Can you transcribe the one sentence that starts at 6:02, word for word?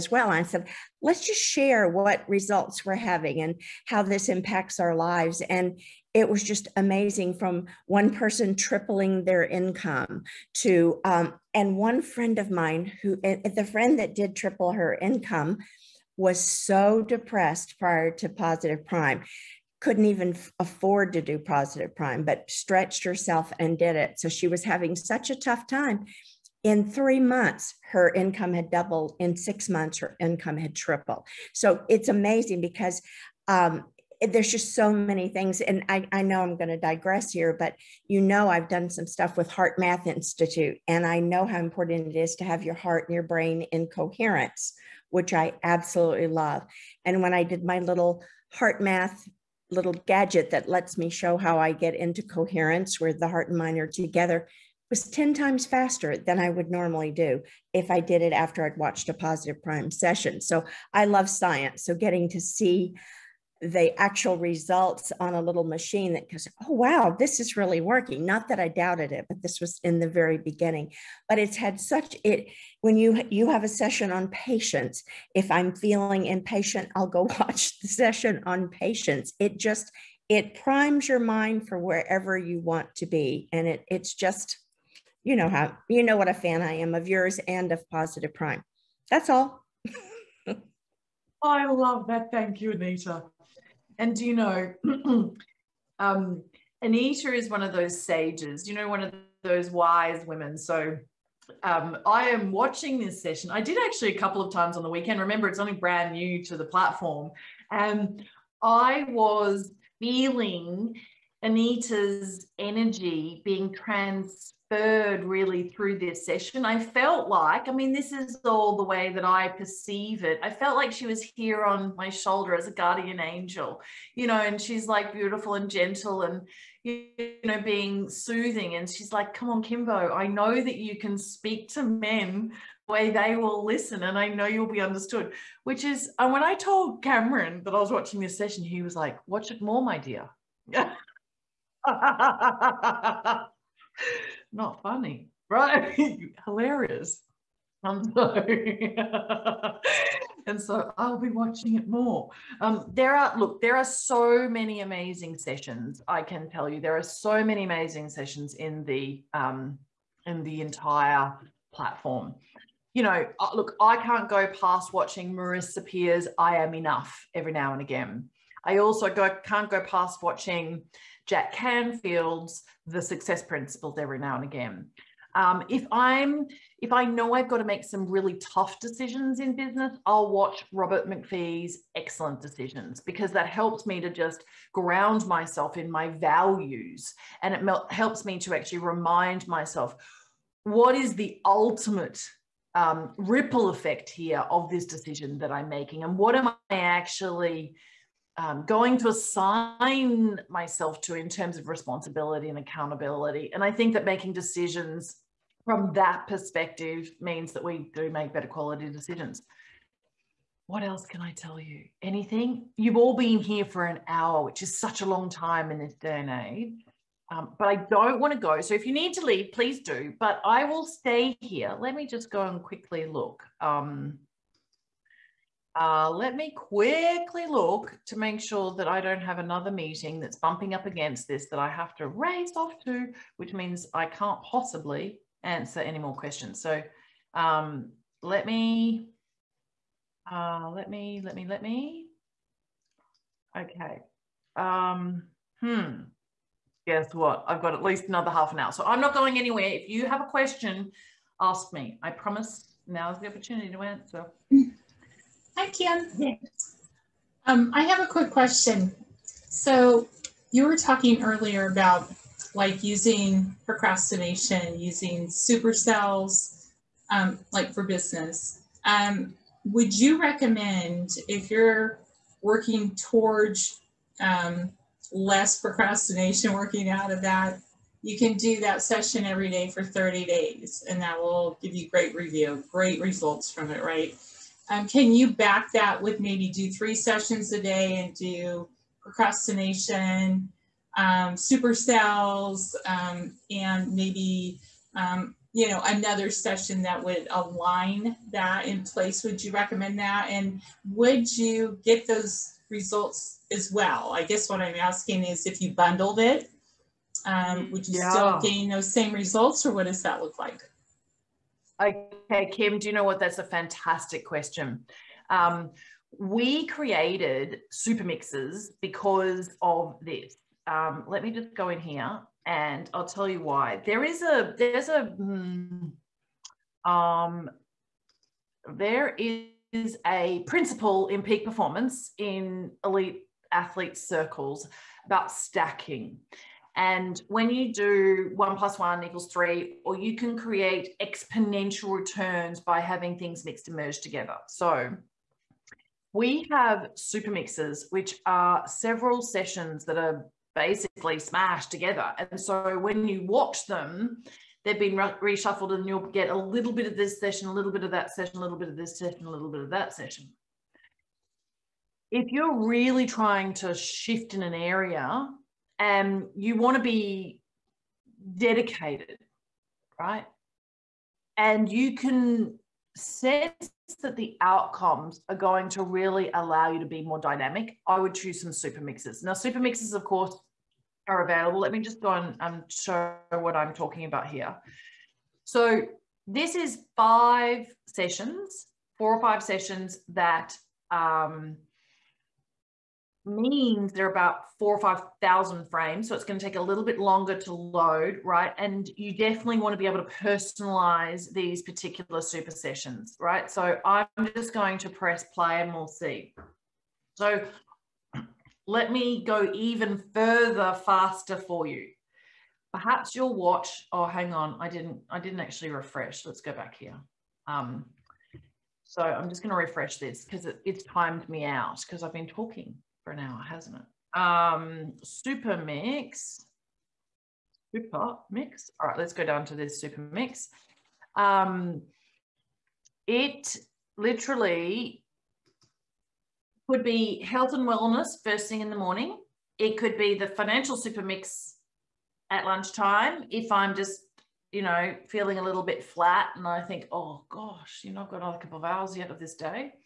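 If you're really trying to shift in an area, um, you want to be dedicated, right?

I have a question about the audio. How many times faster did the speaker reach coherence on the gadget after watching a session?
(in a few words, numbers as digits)
10 times.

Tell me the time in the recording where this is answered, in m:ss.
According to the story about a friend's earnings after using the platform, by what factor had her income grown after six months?
0:30.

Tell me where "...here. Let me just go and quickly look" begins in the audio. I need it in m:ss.
3:41.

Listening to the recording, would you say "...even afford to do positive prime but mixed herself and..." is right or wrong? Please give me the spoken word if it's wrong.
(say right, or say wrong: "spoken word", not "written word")
wrong: "stretched", not "mixed".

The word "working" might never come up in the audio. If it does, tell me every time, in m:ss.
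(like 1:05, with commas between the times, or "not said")
1:07, 4:32, 4:36.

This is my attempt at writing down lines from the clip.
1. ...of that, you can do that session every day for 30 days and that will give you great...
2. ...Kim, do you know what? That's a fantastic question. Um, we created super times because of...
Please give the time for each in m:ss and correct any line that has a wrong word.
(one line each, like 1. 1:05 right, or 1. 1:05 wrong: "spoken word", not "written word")
1. 4:37 right
2. 5:12 wrong: "mixes", not "times".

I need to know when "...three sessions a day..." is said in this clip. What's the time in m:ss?
4:46.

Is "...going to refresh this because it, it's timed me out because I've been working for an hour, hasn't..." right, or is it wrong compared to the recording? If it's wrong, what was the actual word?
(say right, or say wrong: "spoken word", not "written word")
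wrong: "talking", not "working".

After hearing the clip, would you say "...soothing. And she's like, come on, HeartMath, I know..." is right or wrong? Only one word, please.
wrong.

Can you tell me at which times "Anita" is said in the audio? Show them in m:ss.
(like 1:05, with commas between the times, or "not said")
1:32, 1:36, 1:51.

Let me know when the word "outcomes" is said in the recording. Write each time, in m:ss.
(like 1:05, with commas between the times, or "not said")
6:14.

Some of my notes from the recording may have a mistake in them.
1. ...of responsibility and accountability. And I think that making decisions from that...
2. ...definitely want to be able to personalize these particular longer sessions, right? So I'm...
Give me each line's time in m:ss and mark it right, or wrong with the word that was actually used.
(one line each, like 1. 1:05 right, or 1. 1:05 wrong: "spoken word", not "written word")
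1. 3:21 right
2. 6:39 wrong: "super", not "longer".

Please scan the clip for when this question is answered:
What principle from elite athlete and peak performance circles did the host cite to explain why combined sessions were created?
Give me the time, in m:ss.
5:35.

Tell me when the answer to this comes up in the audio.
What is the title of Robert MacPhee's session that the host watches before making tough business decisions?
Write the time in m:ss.
3:01.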